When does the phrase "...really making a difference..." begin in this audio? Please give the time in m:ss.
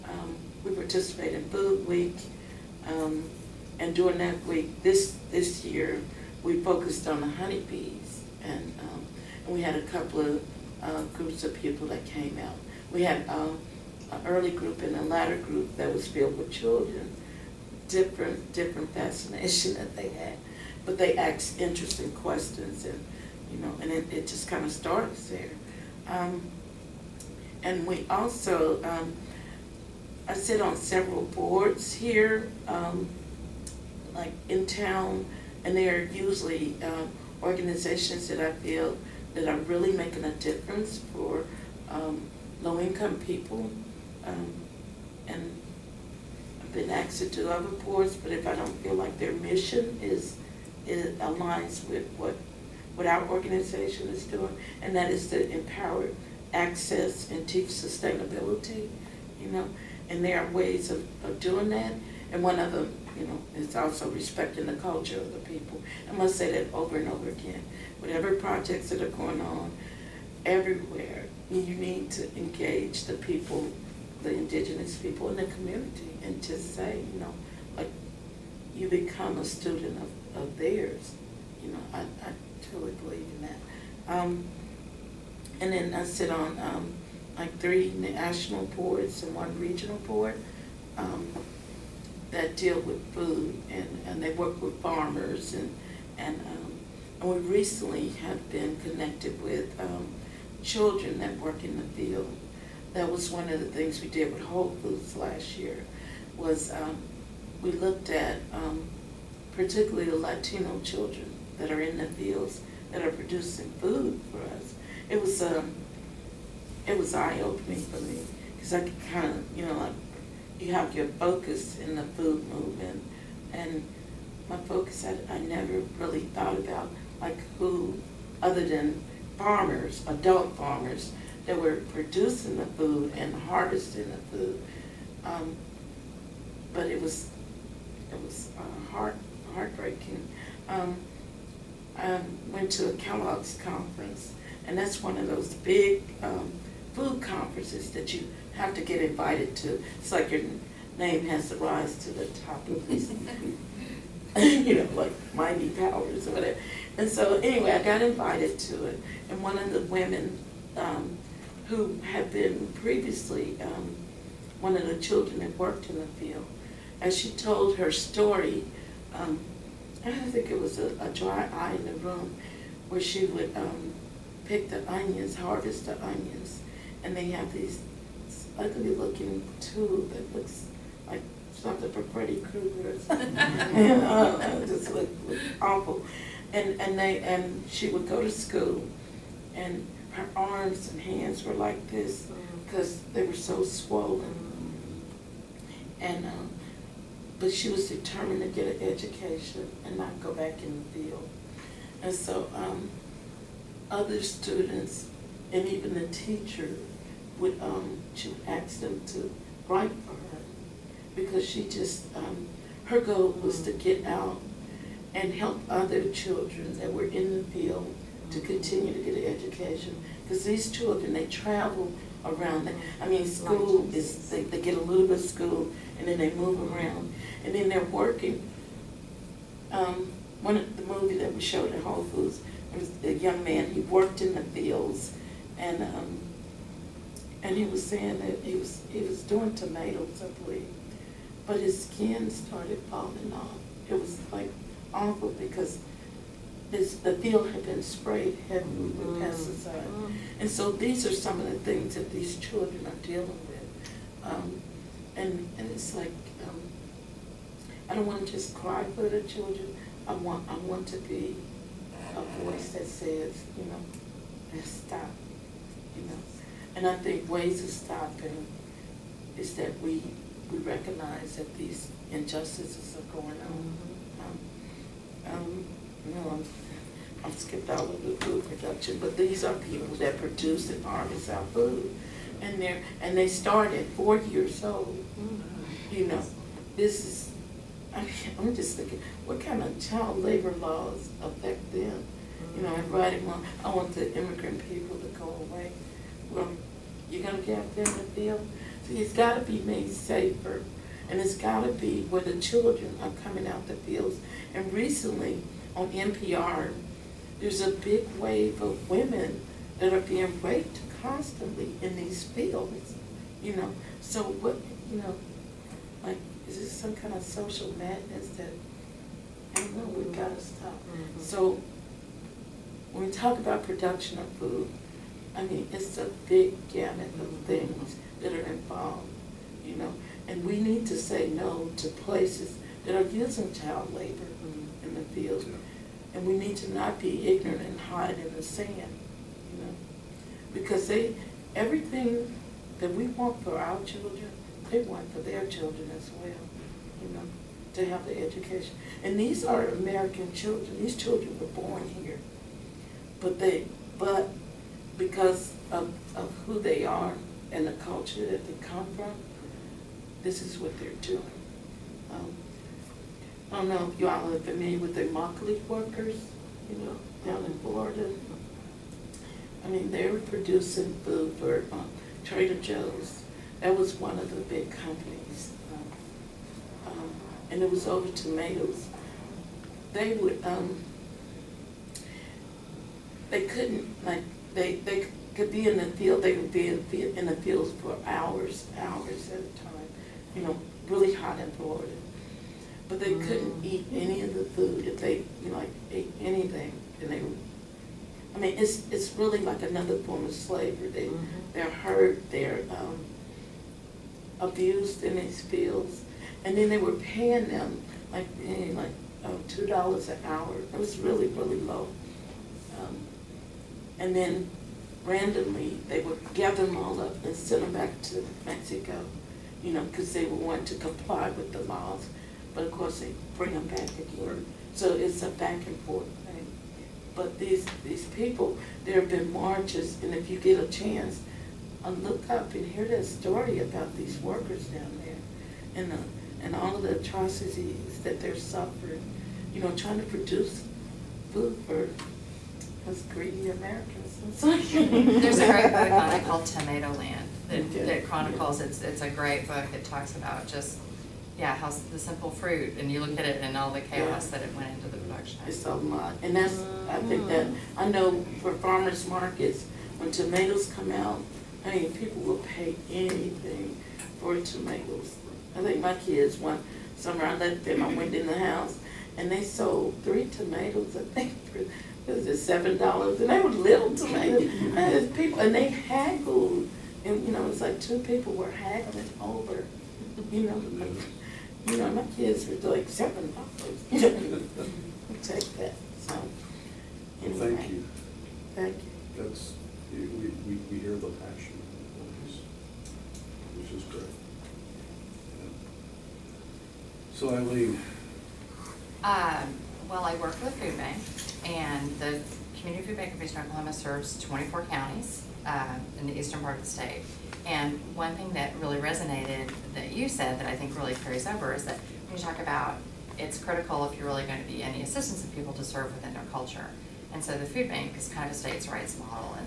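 0:39.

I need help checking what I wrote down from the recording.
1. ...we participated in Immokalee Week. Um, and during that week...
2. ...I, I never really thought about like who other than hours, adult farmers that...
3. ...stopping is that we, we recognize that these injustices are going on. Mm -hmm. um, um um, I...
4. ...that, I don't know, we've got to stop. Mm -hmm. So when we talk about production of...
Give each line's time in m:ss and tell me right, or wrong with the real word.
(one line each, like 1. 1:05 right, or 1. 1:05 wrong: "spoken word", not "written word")
1. 0:00 wrong: "Food", not "Immokalee"
2. 2:05 wrong: "farmers", not "hours"
3. 4:27 right
4. 5:18 right.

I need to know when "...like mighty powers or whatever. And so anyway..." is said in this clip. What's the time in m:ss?
2:34.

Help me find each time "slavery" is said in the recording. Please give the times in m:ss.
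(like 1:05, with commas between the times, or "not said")
6:40.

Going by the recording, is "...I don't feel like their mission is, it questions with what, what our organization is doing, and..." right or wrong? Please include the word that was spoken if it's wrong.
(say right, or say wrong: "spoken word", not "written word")
wrong: "aligns", not "questions".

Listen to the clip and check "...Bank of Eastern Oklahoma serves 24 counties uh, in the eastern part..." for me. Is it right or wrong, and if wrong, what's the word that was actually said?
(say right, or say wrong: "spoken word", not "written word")
right.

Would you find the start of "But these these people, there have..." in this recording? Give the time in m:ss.
7:07.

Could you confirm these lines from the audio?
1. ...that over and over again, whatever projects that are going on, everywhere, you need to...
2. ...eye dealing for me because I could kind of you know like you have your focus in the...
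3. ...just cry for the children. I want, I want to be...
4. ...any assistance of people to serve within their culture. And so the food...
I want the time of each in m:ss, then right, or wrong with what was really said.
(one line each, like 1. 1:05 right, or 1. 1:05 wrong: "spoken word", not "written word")
1. 1:06 right
2. 1:57 wrong: "opening", not "dealing"
3. 4:18 right
4. 8:34 right.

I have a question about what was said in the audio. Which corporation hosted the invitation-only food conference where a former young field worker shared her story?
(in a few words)
Kellogg's.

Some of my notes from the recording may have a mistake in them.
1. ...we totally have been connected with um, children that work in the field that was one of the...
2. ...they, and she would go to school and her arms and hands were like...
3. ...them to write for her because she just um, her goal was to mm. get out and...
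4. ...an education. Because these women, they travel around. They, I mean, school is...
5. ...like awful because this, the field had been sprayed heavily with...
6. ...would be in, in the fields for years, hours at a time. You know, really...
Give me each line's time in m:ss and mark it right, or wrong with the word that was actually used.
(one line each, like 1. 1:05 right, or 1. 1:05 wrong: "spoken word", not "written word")
1. 1:37 wrong: "recently", not "totally"
2. 3:06 right
3. 3:28 right
4. 3:39 wrong: "children", not "women"
5. 4:04 right
6. 6:26 wrong: "hours", not "years".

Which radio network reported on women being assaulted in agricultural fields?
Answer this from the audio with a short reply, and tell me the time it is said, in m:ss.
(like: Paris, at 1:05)
NPR, at 5:05.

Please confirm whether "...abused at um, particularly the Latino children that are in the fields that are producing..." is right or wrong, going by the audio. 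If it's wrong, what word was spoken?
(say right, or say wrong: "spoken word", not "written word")
wrong: "looked", not "abused".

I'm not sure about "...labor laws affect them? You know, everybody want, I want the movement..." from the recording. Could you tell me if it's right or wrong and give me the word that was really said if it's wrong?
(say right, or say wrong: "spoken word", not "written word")
wrong: "immigrant", not "movement".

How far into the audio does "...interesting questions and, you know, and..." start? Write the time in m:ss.
0:21.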